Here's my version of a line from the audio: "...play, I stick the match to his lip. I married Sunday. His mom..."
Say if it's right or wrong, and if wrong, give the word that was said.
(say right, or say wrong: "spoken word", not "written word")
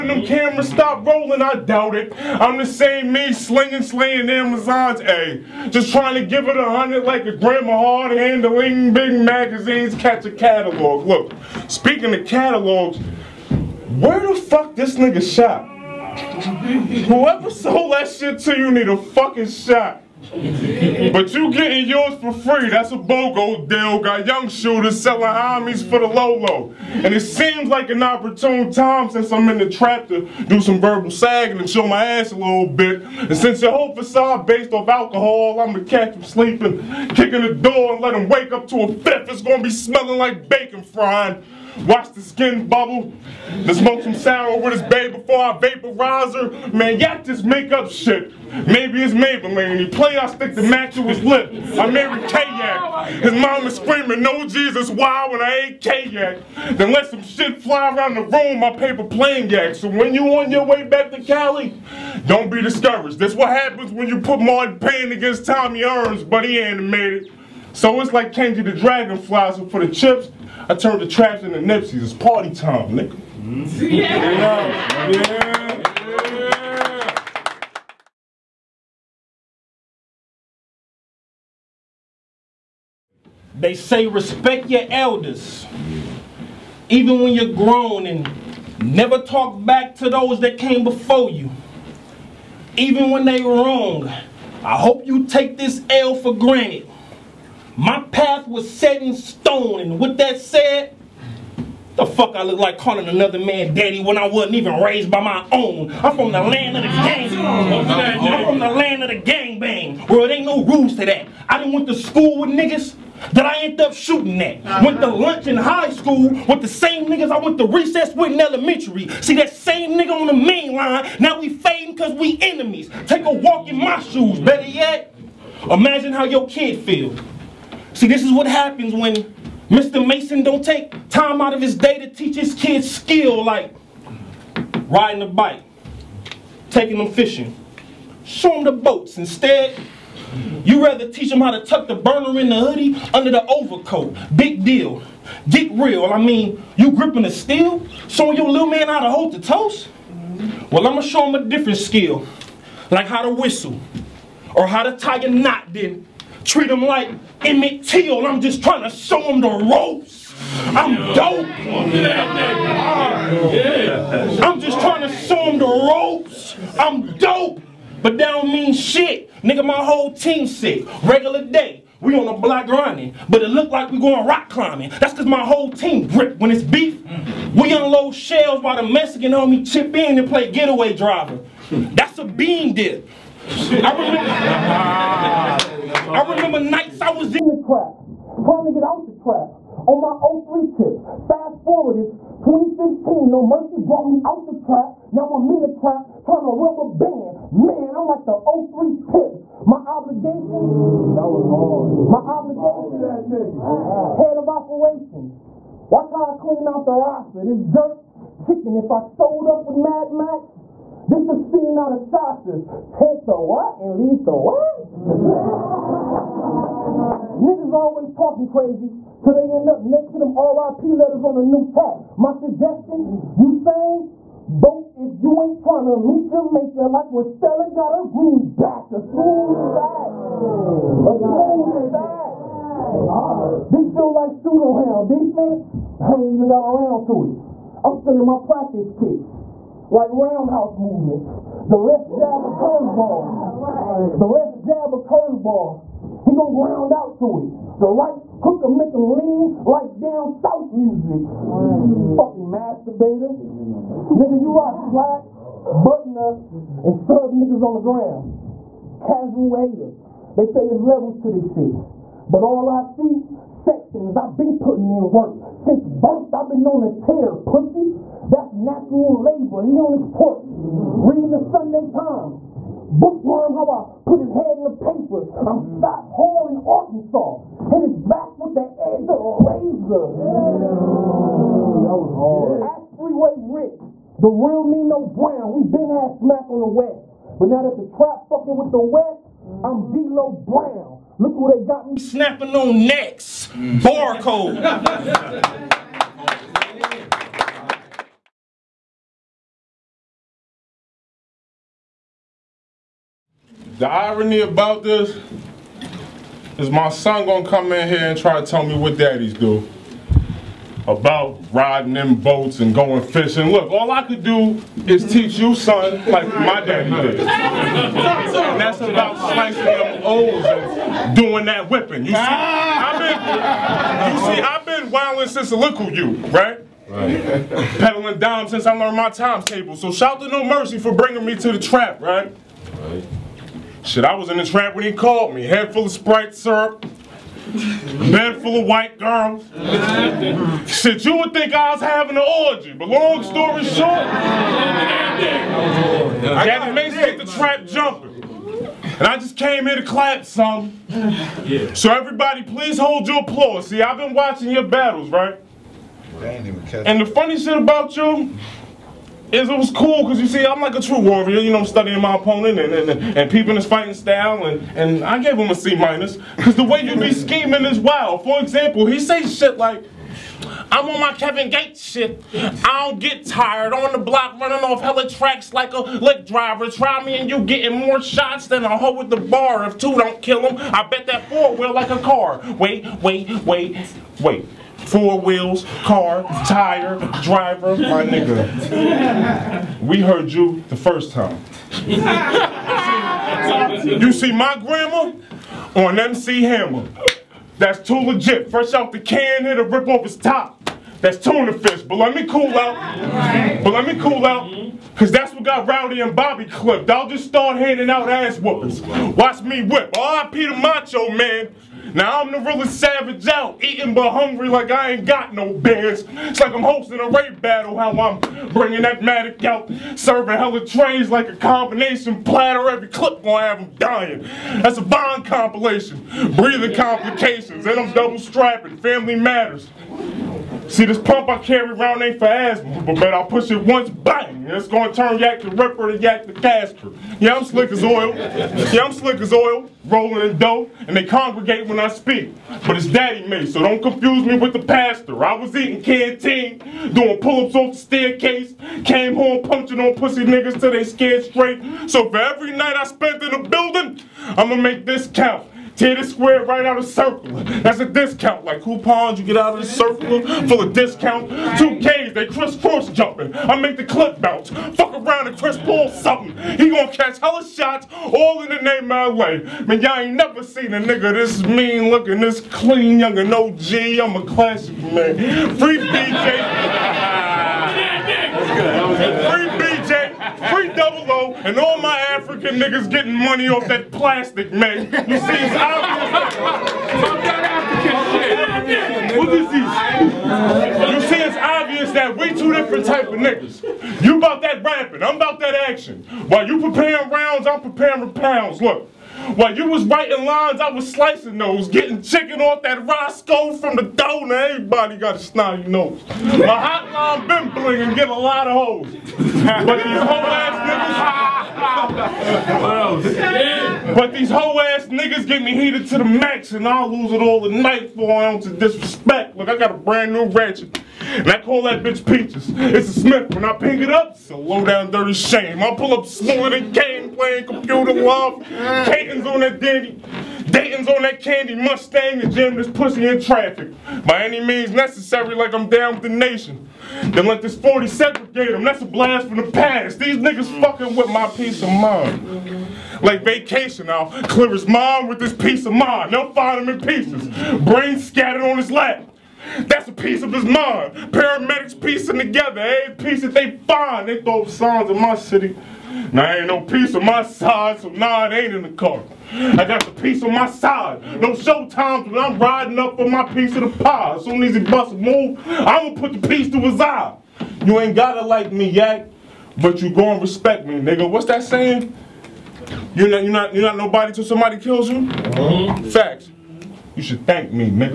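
wrong: "Kayak", not "Sunday".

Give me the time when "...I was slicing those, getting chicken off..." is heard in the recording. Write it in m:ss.
8:20.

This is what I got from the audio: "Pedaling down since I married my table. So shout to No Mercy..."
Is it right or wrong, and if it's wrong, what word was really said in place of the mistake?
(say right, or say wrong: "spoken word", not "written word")
wrong: "learned", not "married".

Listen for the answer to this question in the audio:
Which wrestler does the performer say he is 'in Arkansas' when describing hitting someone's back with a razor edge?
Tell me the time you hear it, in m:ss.
4:35.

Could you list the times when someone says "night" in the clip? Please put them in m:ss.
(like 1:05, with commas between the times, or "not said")
3:06, 7:32, 8:37.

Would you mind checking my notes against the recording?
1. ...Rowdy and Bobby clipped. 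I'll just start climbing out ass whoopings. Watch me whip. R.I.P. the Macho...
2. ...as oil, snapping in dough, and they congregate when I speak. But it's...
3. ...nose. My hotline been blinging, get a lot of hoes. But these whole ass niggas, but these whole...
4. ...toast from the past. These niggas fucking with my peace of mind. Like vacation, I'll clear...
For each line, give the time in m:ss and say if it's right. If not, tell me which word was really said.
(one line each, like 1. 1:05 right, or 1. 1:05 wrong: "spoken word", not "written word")
1. 6:45 wrong: "handing", not "climbing"
2. 7:19 wrong: "rolling", not "snapping"
3. 8:25 right
4. 8:58 wrong: "blast", not "toast".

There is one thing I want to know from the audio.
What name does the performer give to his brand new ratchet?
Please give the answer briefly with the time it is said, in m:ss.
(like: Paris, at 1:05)
Peaches, at 8:42.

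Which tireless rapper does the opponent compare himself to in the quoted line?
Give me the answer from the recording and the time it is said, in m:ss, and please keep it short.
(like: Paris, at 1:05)
Kevin Gates, at 6:11.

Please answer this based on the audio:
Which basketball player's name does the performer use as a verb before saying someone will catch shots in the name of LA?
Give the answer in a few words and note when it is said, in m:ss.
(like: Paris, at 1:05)
Chris Paul, at 7:45.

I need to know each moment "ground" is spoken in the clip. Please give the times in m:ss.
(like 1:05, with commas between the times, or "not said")
4:06, 4:17.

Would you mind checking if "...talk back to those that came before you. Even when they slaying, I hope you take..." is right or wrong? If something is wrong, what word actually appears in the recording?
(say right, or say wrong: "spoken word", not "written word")
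wrong: "wrong", not "slaying".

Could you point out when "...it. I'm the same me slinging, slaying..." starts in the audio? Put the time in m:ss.
0:01.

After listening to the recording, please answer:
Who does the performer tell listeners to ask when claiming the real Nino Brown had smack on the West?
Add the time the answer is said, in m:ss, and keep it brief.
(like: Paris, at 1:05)
Freeway Rick, at 4:42.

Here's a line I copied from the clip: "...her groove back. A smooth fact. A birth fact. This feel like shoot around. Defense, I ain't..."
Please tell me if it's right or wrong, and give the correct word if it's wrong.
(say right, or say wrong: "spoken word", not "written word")
wrong: "smooth", not "birth".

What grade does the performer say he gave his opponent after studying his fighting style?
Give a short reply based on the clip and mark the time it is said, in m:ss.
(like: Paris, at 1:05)
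C minus, at 6:05.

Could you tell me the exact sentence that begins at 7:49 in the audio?
Man, y'all ain't never seen a nigga this mean looking, this clean, young and OG.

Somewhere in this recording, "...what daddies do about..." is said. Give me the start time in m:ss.
5:08.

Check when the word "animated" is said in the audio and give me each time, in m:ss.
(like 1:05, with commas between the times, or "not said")
1:06.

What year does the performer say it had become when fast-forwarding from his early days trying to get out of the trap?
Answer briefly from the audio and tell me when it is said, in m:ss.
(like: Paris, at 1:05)
2015, at 3:12.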